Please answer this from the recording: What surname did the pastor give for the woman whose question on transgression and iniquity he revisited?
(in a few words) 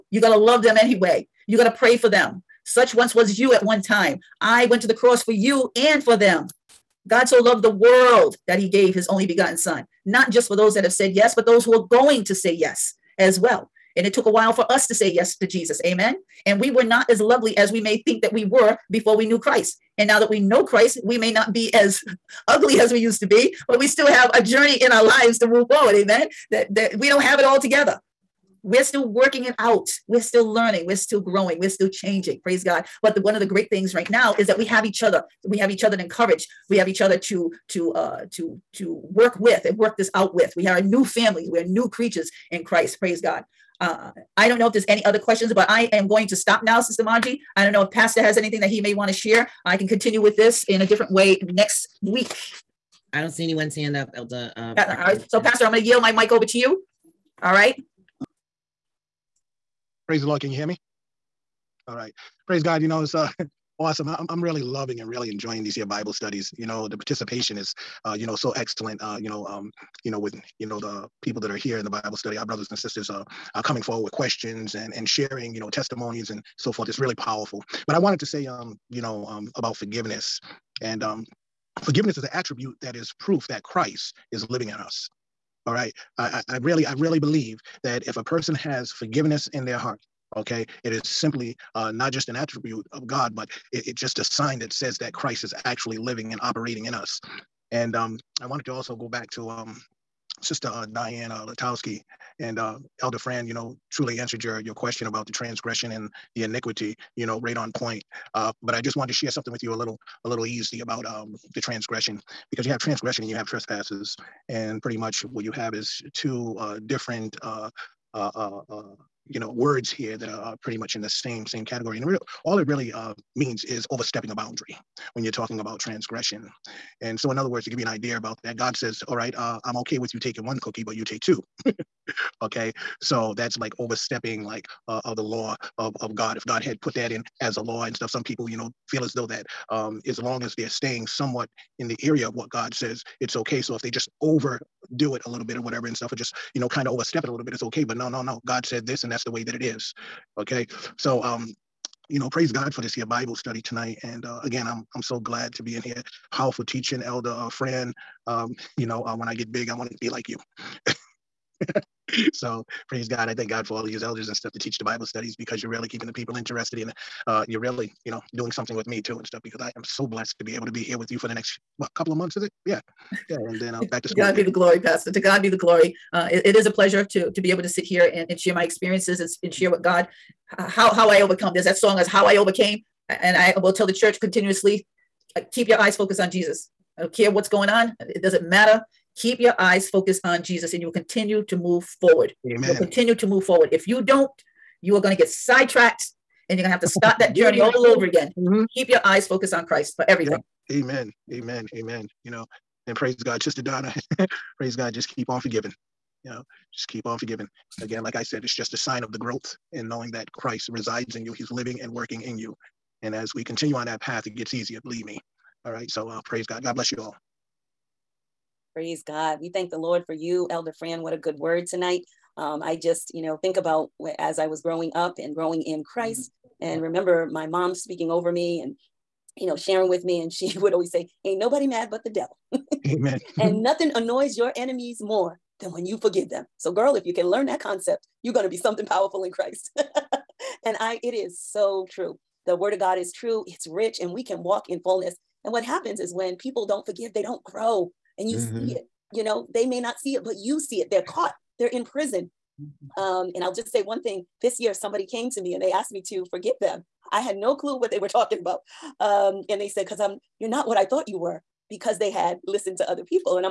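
Latowski.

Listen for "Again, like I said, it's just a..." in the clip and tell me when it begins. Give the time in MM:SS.
03:27.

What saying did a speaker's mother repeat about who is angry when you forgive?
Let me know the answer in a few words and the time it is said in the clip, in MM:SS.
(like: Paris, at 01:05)
Ain't nobody mad but the devil, at 03:51.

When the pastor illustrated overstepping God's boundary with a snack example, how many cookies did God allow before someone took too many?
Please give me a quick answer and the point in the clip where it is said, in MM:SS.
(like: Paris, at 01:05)
1, at 02:10.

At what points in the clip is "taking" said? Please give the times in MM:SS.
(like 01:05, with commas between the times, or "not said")
02:10.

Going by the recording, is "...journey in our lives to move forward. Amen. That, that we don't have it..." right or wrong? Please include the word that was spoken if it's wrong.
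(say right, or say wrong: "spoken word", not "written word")
right.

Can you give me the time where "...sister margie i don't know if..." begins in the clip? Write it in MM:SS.
00:46.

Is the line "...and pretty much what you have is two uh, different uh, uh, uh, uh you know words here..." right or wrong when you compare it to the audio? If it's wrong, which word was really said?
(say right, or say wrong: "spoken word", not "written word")
right.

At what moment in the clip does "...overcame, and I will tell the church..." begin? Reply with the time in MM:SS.
03:02.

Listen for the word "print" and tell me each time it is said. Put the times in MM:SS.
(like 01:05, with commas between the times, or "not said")
not said.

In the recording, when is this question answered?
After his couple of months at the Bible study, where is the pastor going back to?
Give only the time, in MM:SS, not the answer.
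02:54.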